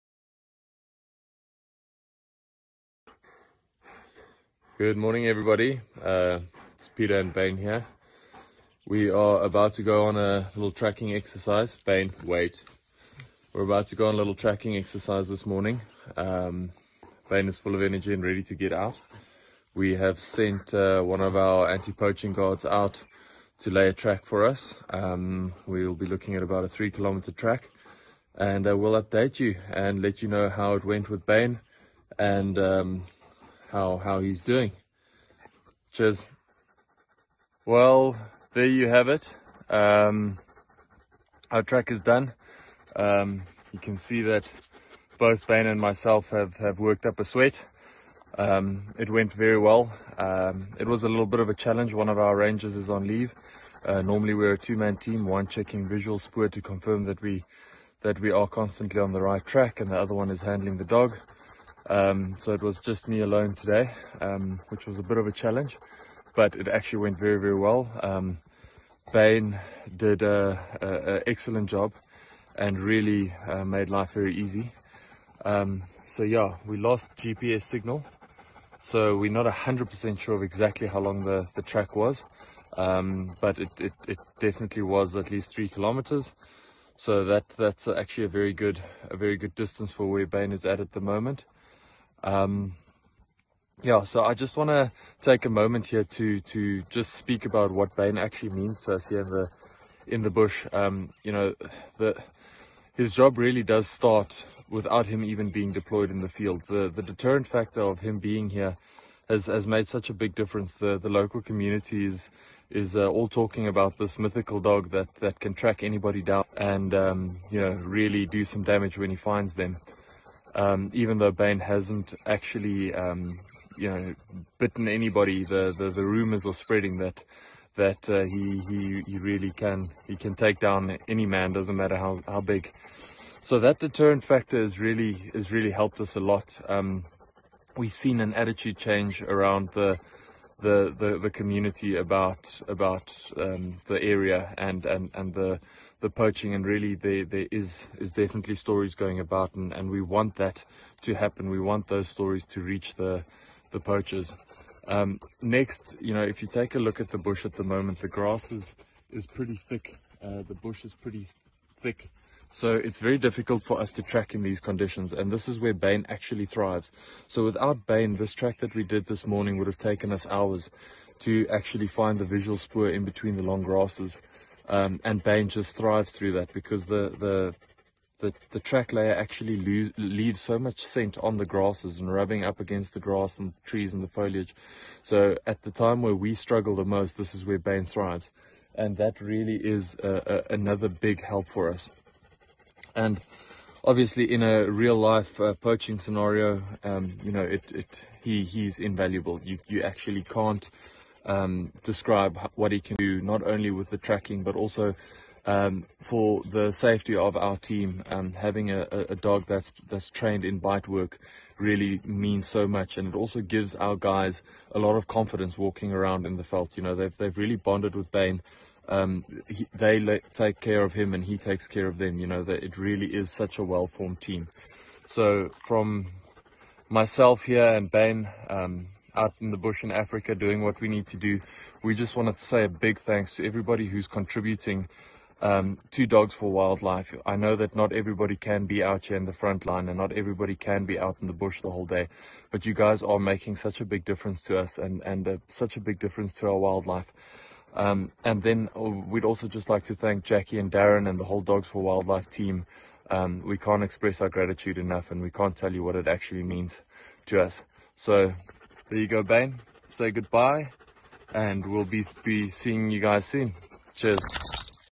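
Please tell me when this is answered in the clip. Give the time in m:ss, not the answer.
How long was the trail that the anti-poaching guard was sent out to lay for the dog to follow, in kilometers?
0:26.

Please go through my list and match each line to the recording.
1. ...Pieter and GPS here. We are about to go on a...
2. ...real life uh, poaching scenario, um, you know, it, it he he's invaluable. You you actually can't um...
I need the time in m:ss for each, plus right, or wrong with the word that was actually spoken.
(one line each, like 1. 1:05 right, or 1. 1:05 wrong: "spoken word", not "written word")
1. 0:06 wrong: "Bane", not "GPS"
2. 3:14 right.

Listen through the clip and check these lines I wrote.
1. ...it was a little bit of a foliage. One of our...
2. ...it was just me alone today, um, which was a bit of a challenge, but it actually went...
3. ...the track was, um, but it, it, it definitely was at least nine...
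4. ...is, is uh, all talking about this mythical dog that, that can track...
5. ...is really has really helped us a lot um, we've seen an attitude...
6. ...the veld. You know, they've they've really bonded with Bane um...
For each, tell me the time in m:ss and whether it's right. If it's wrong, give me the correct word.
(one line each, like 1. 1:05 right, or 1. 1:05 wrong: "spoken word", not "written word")
1. 0:50 wrong: "challenge", not "foliage"
2. 1:02 right
3. 1:21 wrong: "three", not "nine"
4. 1:52 right
5. 2:14 right
6. 3:36 right.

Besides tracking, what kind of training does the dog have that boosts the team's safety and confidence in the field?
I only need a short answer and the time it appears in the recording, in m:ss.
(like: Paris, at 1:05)
Bite work, at 3:30.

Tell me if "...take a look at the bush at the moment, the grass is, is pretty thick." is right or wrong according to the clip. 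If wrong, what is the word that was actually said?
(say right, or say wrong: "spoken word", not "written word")
right.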